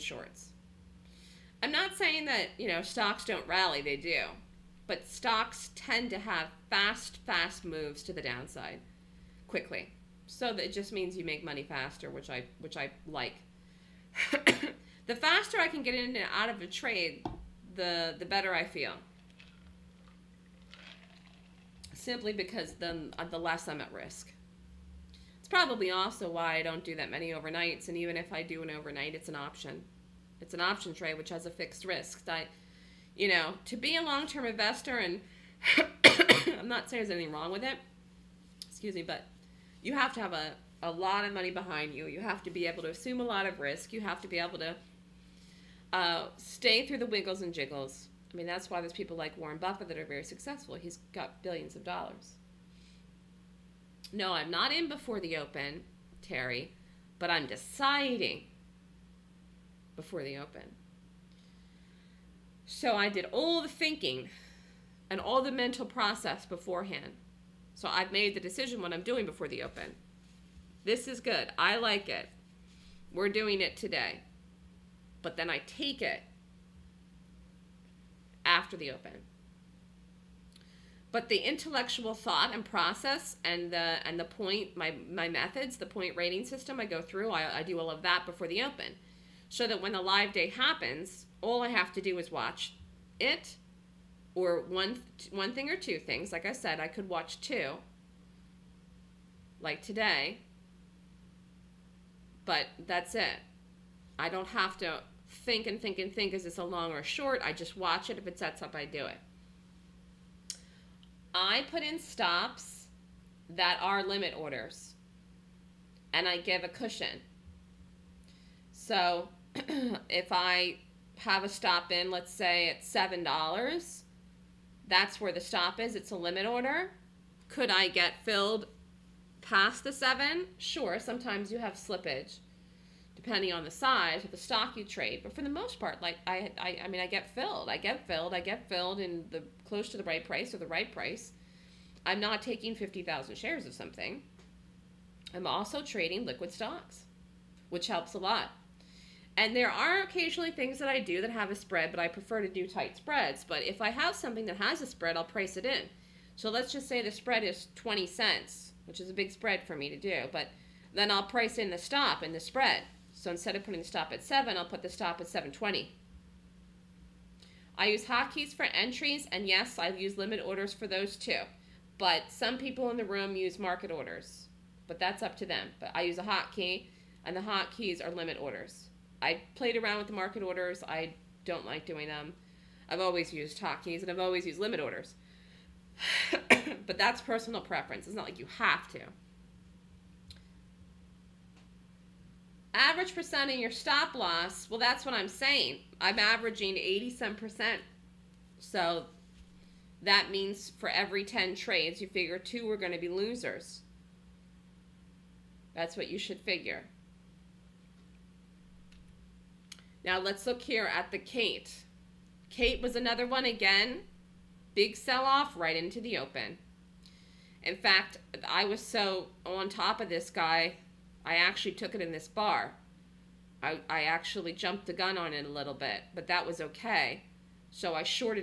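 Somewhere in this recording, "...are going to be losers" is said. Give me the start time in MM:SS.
03:22.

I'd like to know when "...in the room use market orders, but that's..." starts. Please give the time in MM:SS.
02:52.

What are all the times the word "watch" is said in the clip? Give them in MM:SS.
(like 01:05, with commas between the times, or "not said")
01:32, 01:37, 01:47.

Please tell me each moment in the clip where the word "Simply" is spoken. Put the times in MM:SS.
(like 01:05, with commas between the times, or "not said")
00:21.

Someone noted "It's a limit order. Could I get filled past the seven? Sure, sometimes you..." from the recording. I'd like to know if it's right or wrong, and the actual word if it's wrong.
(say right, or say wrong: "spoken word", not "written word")
right.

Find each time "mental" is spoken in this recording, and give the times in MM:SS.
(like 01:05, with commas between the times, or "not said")
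01:05.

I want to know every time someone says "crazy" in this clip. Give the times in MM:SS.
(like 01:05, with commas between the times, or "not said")
not said.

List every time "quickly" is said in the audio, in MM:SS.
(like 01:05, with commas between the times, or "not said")
00:09.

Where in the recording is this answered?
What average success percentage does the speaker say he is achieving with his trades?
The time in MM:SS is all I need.
03:16.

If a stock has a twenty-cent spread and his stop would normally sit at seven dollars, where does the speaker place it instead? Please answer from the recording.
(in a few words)
$7.20.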